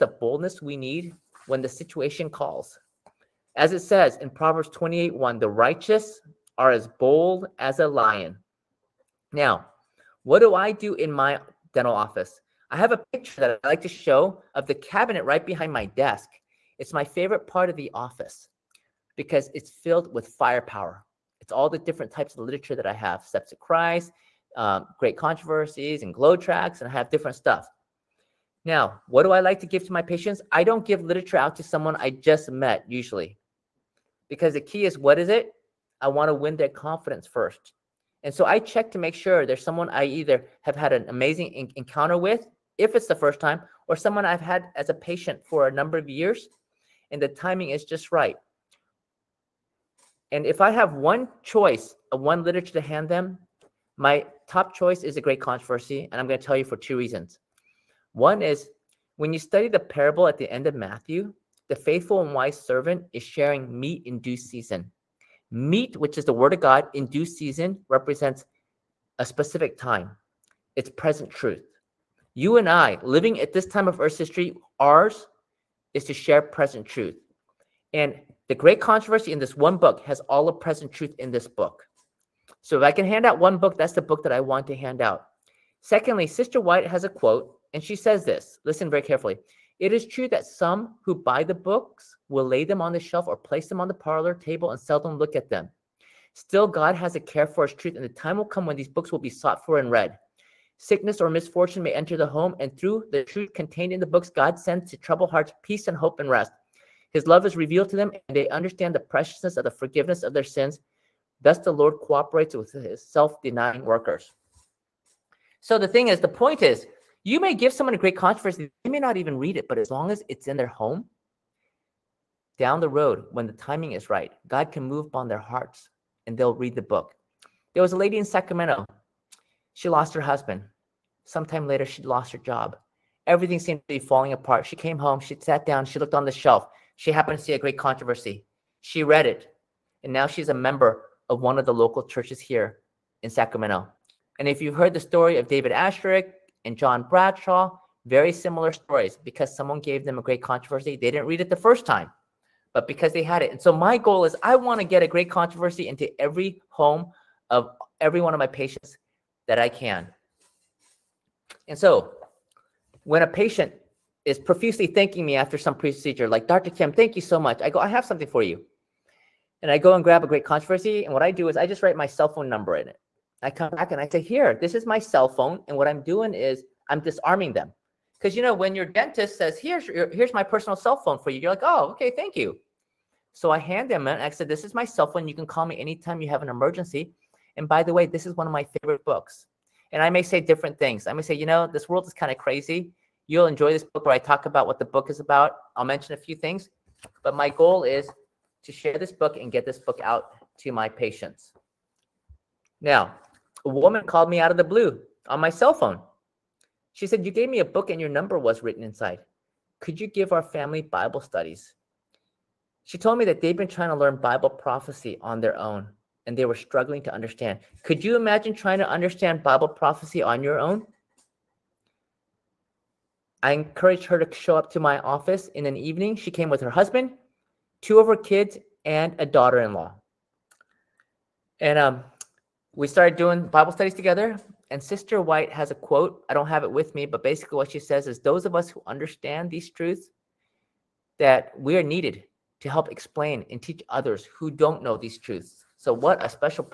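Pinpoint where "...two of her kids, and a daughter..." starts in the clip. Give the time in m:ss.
3:47.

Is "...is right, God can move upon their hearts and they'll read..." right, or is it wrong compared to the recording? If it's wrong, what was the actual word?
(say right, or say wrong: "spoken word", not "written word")
right.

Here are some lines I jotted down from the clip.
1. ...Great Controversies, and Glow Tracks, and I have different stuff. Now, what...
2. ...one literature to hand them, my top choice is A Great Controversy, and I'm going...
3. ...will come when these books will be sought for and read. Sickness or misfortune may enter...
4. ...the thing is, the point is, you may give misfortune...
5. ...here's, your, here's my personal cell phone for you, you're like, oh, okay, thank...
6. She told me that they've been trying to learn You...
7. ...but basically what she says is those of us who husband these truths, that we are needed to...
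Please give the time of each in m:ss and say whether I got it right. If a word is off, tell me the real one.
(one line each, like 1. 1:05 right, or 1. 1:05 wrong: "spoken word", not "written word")
1. 0:24 right
2. 0:52 right
3. 1:38 right
4. 1:55 wrong: "someone", not "misfortune"
5. 2:59 right
6. 3:32 wrong: "Bible", not "You"
7. 3:57 wrong: "understand", not "husband".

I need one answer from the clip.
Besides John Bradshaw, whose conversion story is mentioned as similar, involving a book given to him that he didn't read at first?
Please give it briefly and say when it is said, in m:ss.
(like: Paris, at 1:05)
David Asscherick, at 2:25.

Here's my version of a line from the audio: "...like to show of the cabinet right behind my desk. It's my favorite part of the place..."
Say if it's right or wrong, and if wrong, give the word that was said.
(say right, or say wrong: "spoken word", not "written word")
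wrong: "office", not "place".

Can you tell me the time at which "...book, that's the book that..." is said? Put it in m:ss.
1:23.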